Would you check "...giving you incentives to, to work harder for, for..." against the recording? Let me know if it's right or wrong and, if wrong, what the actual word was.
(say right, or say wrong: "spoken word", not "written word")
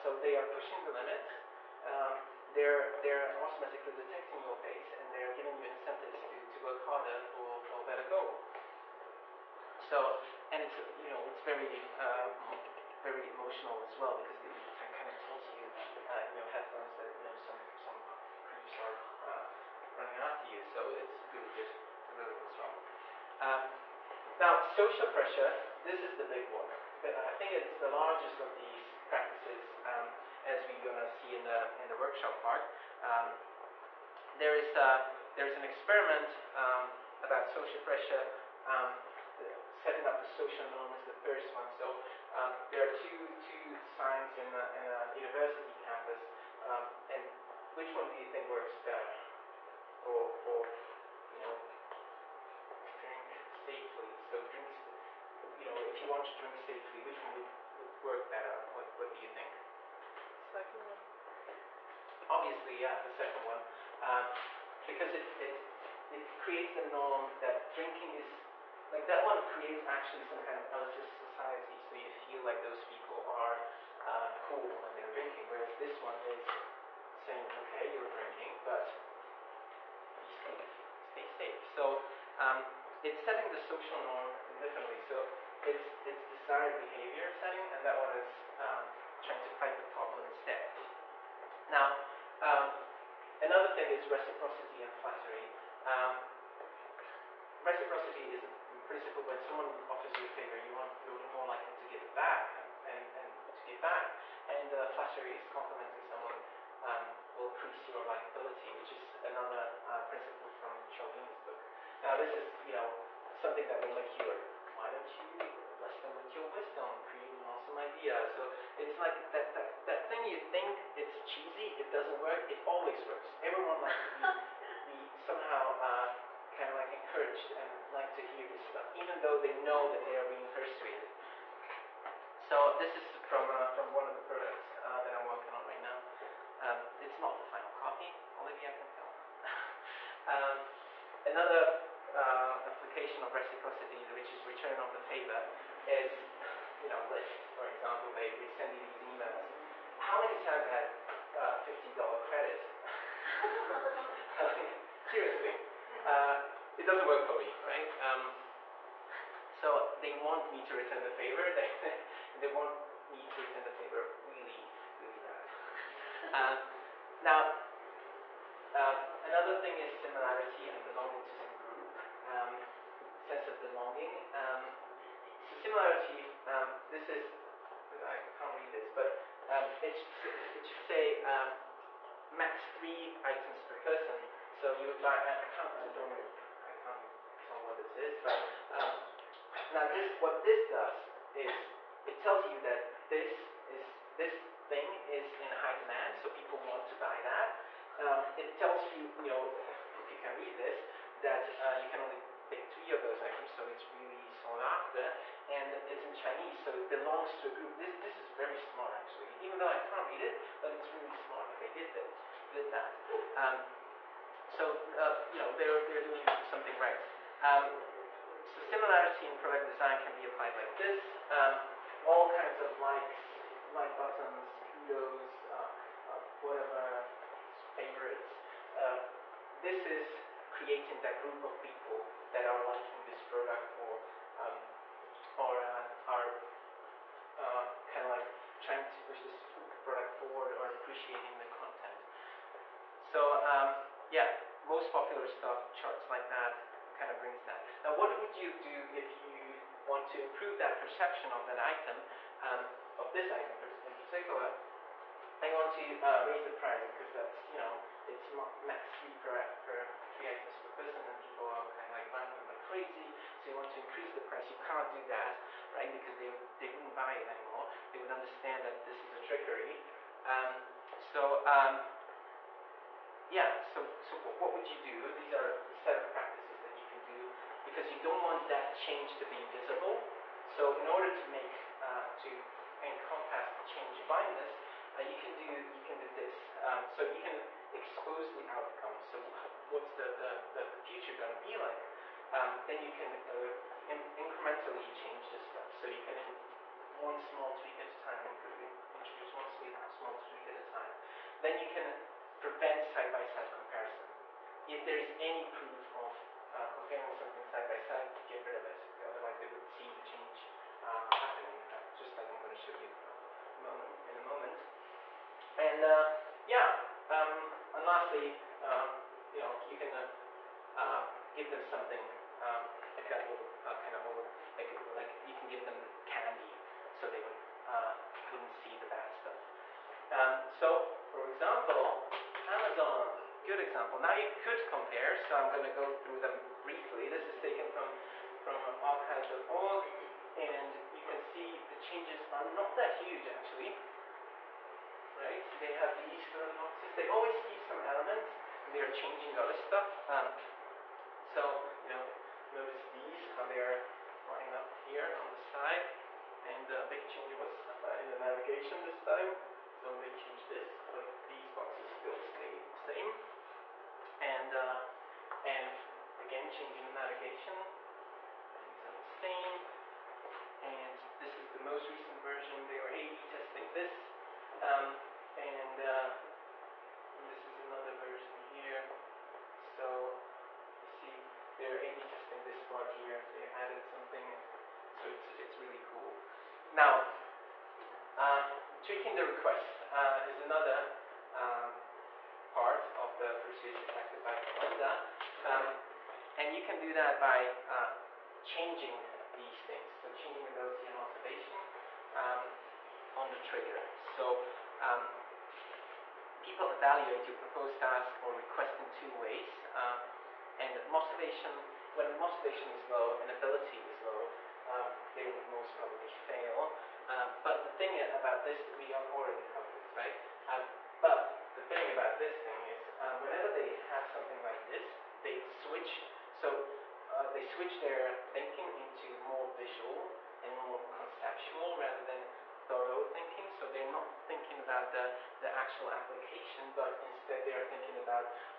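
right.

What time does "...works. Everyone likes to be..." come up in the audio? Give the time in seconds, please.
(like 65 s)
123 s.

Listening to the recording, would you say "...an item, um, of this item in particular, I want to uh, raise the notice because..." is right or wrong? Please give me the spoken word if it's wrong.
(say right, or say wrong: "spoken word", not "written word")
wrong: "price", not "notice".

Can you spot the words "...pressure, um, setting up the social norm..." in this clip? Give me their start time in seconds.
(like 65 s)
37 s.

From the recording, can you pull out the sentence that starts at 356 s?
And the uh, big change was uh, in the navigation this time.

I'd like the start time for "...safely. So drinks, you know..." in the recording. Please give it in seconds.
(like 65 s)
53 s.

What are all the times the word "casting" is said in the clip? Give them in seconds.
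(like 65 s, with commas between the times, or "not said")
not said.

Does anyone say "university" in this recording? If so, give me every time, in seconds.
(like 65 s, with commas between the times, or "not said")
45 s.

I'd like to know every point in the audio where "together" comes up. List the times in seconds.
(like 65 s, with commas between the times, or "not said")
not said.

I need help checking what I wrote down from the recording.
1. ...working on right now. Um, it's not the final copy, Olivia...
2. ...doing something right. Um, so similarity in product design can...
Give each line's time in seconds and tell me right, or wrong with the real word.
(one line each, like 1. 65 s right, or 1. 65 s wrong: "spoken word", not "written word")
1. 135 s right
2. 216 s right.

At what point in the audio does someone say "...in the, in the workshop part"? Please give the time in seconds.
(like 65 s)
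31 s.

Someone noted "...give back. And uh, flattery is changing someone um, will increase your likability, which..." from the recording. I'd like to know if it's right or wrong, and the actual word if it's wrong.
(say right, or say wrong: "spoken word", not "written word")
wrong: "complimenting", not "changing".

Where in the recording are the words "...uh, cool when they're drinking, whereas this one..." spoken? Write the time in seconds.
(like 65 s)
74 s.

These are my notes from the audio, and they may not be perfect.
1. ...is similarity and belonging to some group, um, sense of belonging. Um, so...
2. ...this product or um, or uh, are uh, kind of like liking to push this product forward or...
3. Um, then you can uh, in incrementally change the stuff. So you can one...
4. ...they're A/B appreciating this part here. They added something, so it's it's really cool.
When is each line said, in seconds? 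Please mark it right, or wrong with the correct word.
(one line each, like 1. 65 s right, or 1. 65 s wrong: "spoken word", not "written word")
1. 169 s right
2. 233 s wrong: "trying", not "liking"
3. 292 s right
4. 381 s wrong: "testing", not "appreciating".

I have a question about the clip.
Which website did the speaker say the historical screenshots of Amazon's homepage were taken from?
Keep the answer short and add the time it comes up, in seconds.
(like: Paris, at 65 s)
archives.org, at 338 s.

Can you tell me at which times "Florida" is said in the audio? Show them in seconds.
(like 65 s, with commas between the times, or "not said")
not said.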